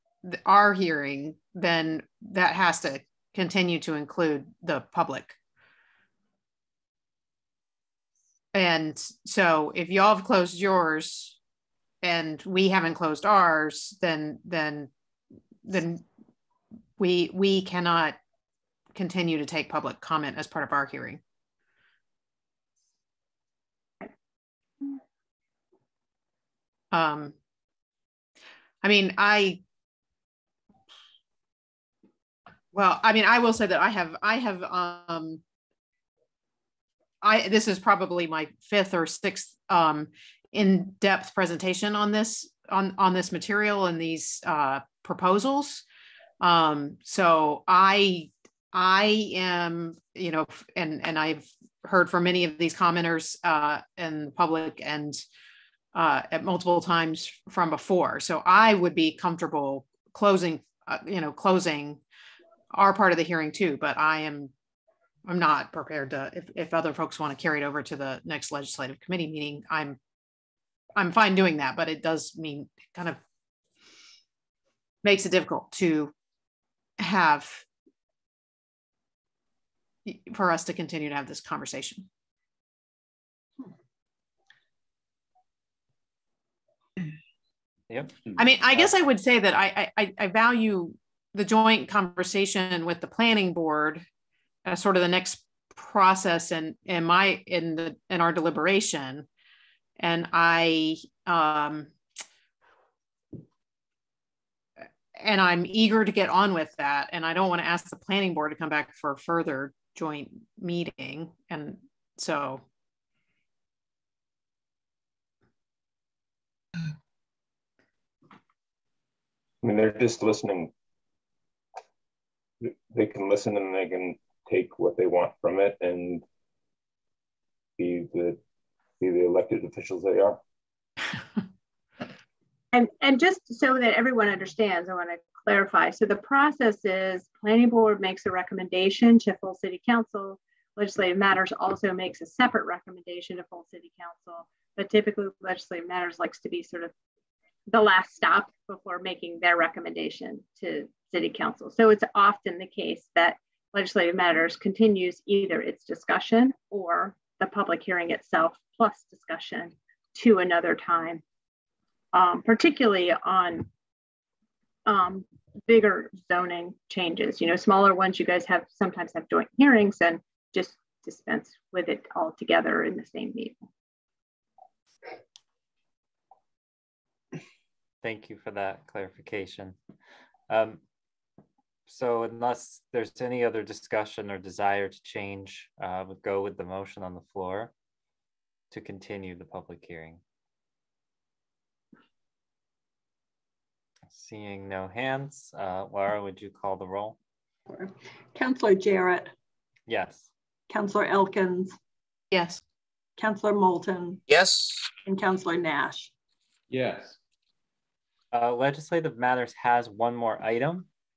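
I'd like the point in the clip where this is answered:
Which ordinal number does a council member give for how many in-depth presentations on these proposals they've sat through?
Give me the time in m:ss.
0:38.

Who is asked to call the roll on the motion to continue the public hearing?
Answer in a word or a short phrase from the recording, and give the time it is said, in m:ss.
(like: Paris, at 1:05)
Laura, at 3:15.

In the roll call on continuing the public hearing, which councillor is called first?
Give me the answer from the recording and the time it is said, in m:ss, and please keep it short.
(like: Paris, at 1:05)
Councillor Jarrett, at 3:18.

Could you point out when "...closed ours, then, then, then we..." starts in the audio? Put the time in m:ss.
0:12.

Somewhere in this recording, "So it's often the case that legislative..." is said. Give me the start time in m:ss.
2:31.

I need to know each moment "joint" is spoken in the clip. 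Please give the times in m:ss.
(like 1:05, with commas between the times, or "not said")
1:31, 1:49, 2:49.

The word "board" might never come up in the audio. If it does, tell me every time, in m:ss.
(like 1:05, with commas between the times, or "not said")
1:33, 1:48, 2:17.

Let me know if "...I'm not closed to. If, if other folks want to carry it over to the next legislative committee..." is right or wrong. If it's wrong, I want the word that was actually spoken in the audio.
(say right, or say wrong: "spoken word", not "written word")
wrong: "prepared", not "closed".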